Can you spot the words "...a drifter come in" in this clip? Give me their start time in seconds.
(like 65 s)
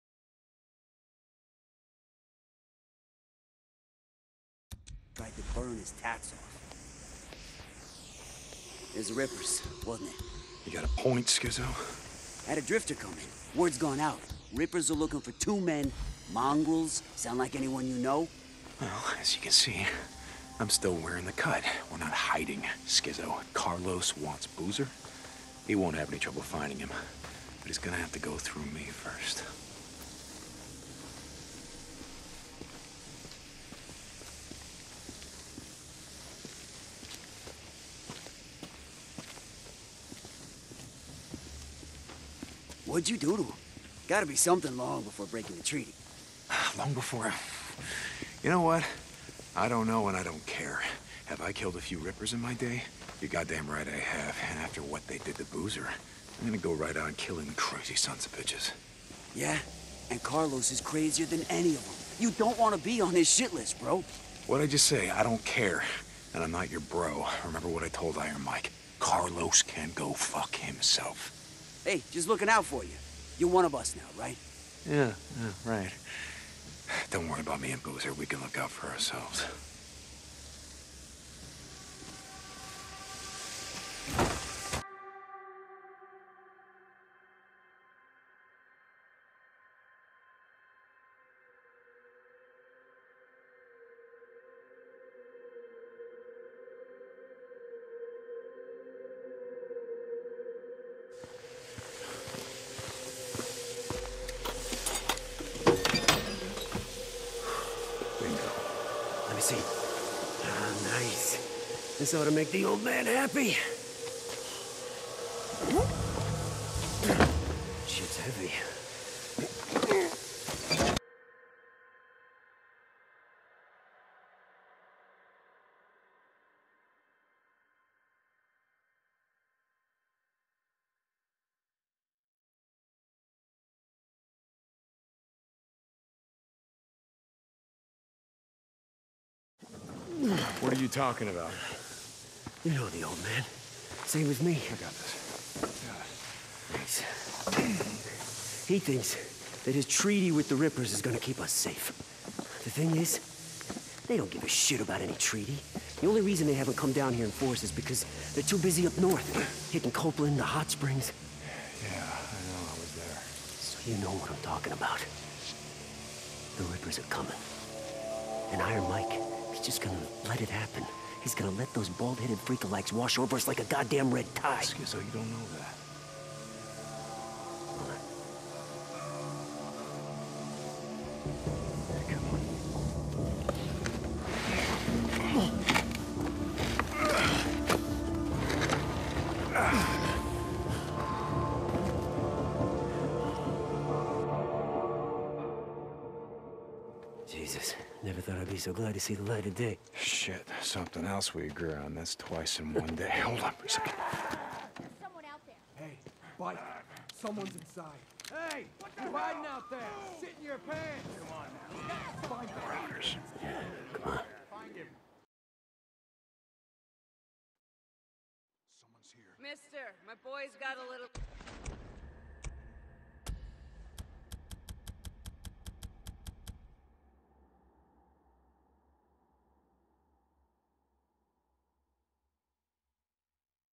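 12 s.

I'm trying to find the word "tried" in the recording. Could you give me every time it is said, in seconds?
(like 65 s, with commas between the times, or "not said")
5 s.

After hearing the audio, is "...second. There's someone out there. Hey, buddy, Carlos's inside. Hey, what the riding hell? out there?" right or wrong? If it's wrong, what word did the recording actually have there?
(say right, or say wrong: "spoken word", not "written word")
wrong: "Someone", not "Carlos".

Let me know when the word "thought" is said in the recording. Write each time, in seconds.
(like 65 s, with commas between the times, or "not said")
198 s.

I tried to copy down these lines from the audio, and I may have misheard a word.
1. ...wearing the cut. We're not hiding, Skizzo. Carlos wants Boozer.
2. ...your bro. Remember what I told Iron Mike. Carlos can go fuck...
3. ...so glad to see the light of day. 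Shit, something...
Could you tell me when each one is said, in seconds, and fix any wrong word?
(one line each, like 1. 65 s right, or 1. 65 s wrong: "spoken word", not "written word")
1. 20 s right
2. 66 s right
3. 198 s right.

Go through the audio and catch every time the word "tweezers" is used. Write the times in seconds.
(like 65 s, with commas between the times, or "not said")
not said.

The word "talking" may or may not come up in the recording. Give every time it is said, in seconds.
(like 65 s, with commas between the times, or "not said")
140 s, 164 s.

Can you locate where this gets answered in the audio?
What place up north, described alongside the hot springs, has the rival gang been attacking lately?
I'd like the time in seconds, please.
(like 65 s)
159 s.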